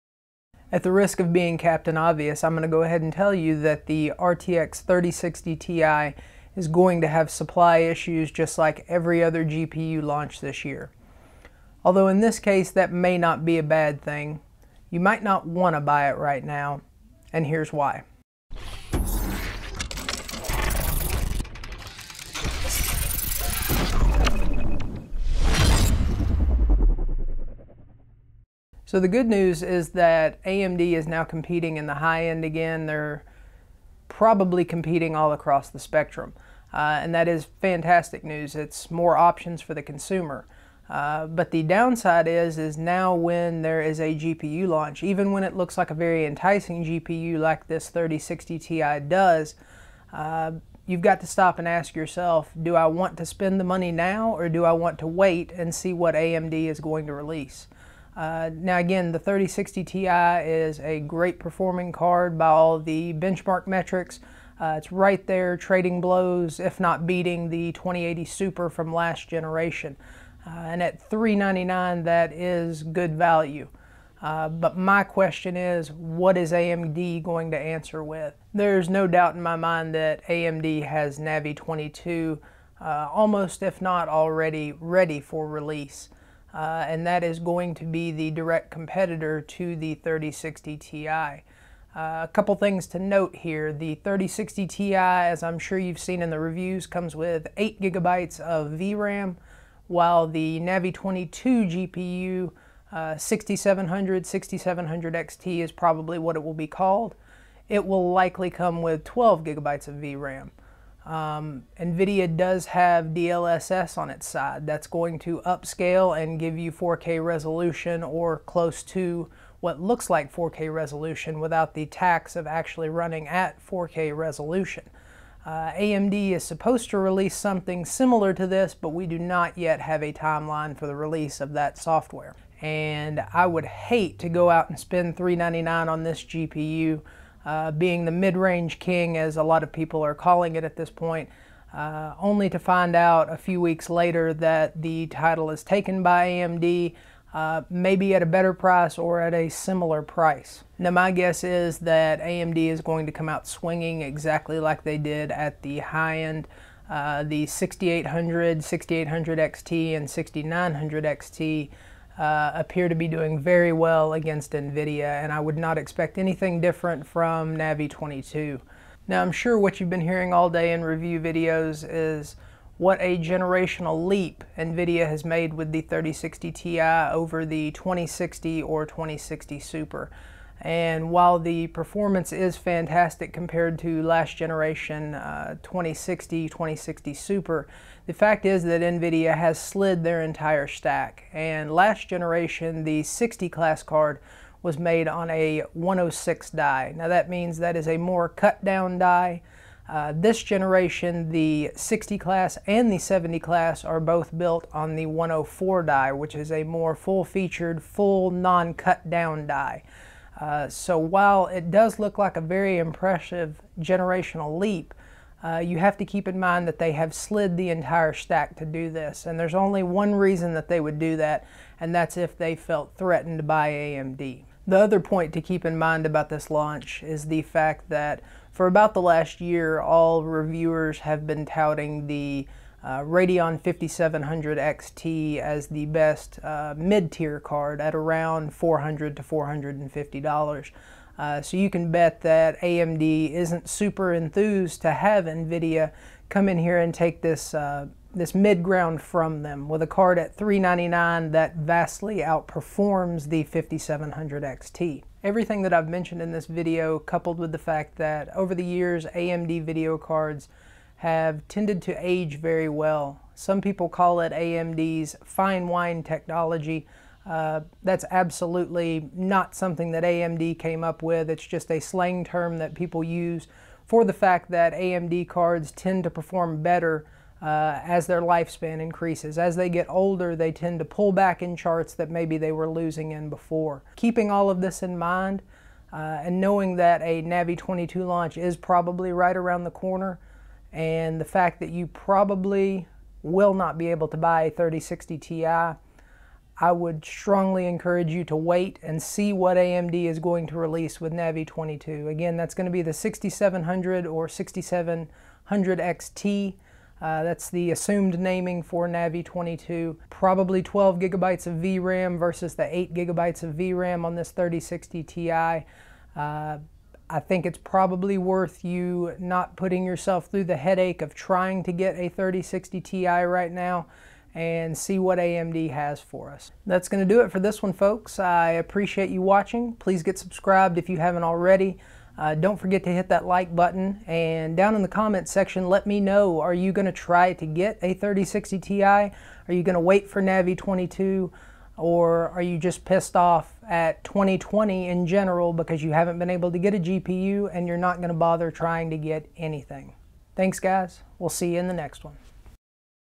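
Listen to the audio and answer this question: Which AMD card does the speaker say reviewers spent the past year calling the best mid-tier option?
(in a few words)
Radeon 5700 XT.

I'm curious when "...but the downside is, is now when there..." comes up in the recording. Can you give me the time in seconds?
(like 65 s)
41 s.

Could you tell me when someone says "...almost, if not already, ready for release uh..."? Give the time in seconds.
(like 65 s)
83 s.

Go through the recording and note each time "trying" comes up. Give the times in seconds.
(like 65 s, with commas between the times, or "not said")
321 s, 348 s.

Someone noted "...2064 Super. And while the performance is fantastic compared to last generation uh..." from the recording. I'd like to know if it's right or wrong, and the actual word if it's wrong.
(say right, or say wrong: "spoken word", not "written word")
wrong: "2060", not "2064".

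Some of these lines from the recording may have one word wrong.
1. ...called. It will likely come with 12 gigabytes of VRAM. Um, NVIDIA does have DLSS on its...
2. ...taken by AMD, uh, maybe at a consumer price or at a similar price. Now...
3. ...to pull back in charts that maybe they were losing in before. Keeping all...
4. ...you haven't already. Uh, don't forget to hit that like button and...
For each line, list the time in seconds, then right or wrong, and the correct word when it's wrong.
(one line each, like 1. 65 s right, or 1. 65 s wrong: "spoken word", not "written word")
1. 106 s right
2. 145 s wrong: "better", not "consumer"
3. 280 s right
4. 330 s right.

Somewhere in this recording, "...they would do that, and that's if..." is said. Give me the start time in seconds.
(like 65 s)
220 s.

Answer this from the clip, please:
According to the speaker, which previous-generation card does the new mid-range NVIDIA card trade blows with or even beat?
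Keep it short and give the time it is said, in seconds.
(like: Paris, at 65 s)
2080 Super, at 67 s.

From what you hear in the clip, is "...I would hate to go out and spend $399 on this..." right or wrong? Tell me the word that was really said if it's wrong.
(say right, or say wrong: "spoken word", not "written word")
right.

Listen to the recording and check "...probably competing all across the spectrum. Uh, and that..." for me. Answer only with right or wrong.
right.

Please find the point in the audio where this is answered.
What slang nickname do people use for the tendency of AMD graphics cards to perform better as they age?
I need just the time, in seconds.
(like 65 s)
265 s.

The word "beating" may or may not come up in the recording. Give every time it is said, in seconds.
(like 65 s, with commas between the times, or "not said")
67 s.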